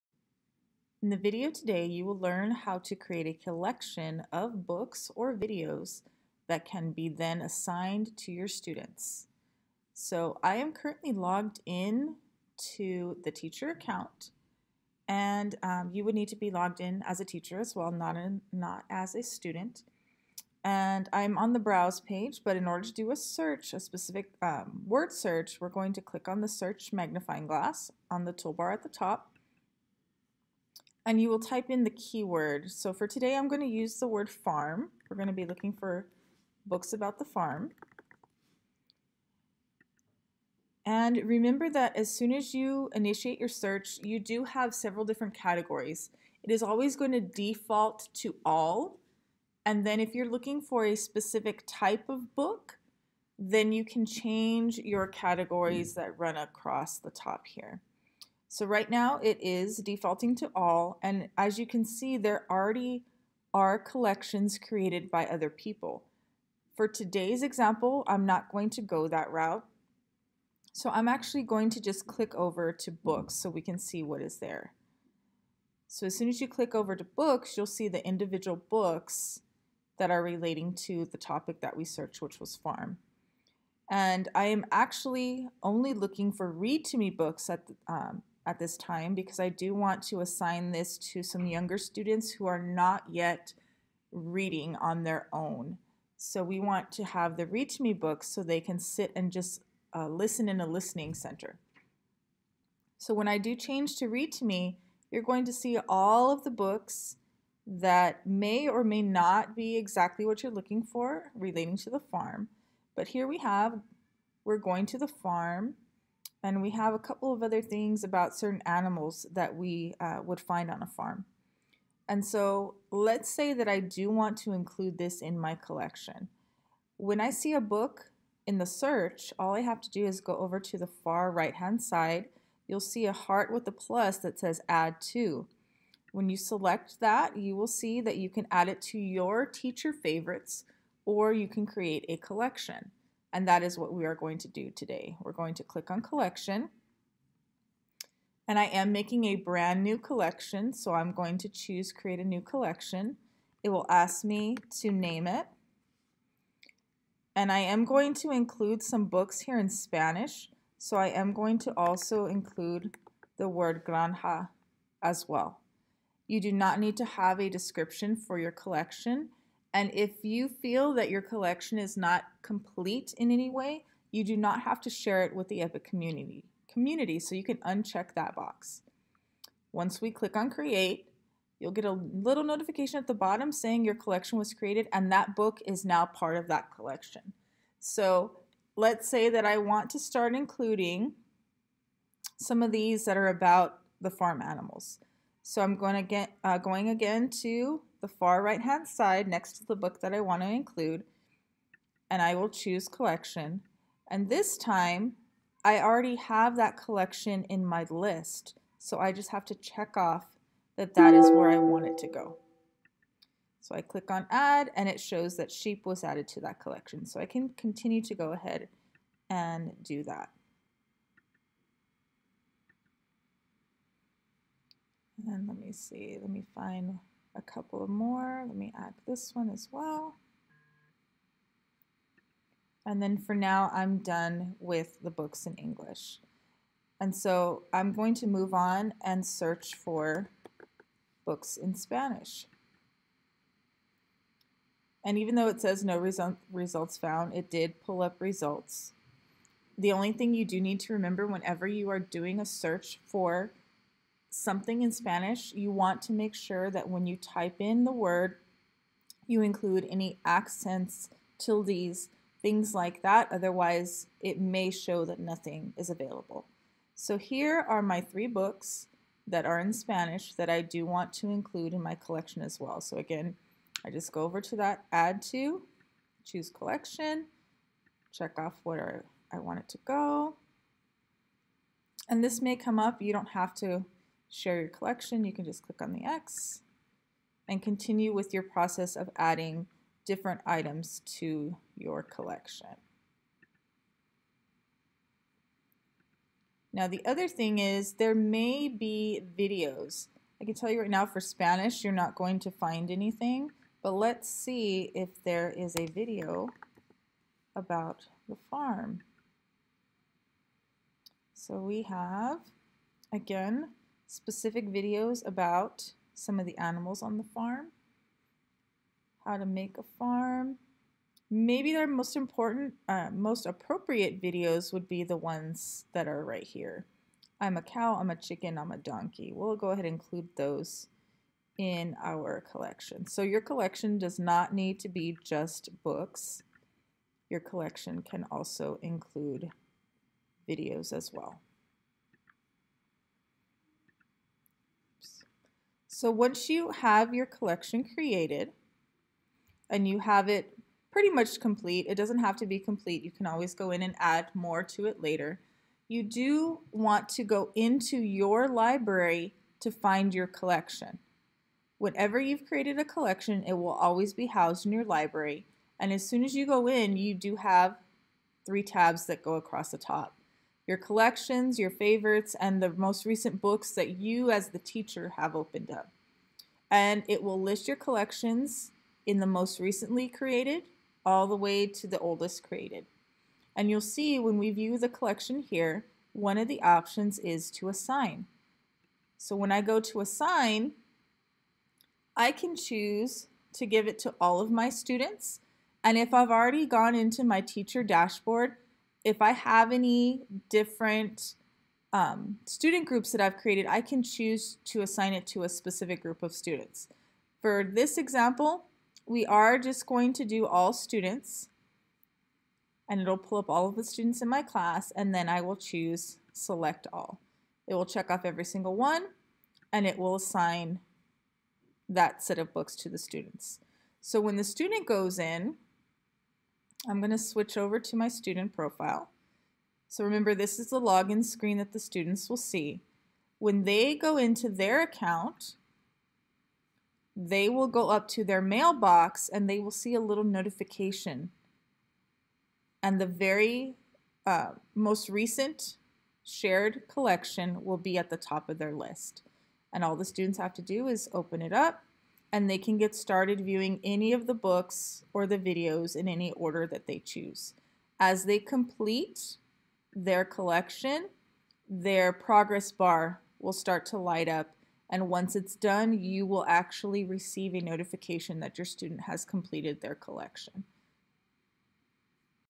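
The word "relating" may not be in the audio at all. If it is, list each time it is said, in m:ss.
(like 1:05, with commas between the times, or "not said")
1:20, 1:51.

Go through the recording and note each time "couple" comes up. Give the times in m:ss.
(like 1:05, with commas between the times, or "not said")
1:56, 3:47.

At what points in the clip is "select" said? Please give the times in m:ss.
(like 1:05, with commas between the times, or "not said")
2:16, 6:56.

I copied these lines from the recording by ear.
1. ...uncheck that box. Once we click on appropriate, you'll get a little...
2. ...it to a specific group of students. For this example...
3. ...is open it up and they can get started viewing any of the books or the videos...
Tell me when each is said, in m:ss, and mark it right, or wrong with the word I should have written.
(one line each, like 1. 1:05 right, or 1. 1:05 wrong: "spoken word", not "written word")
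1. 2:57 wrong: "create", not "appropriate"
2. 6:45 right
3. 7:30 right.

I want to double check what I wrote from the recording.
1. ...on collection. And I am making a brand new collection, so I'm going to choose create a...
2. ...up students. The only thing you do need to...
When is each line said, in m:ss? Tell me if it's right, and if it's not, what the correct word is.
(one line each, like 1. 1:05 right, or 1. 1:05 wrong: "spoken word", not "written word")
1. 2:25 right
2. 4:08 wrong: "results", not "students".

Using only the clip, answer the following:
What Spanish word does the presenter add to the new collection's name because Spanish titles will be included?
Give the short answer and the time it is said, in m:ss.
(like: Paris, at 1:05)
granja, at 2:43.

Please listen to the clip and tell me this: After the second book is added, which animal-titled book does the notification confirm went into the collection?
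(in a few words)
sheep.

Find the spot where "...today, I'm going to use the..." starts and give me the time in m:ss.
0:33.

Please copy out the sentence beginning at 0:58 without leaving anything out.
So right now it is defaulting to all, and as you can see, there already are collections created by other people.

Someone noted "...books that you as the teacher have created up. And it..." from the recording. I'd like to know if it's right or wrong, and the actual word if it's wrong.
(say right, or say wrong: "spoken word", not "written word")
wrong: "opened", not "created".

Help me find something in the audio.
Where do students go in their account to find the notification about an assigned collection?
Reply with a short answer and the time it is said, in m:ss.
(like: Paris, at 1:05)
mailbox, at 7:18.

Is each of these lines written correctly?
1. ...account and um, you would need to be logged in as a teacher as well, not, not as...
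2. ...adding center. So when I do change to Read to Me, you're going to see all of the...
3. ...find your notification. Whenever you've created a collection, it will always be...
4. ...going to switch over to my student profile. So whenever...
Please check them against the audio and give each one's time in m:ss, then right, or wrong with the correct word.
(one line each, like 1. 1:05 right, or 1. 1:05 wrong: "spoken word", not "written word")
1. 0:13 right
2. 1:40 wrong: "listening", not "adding"
3. 5:59 wrong: "collection", not "notification"
4. 7:06 wrong: "remember", not "whenever".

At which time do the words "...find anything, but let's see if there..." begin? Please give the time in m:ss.
5:02.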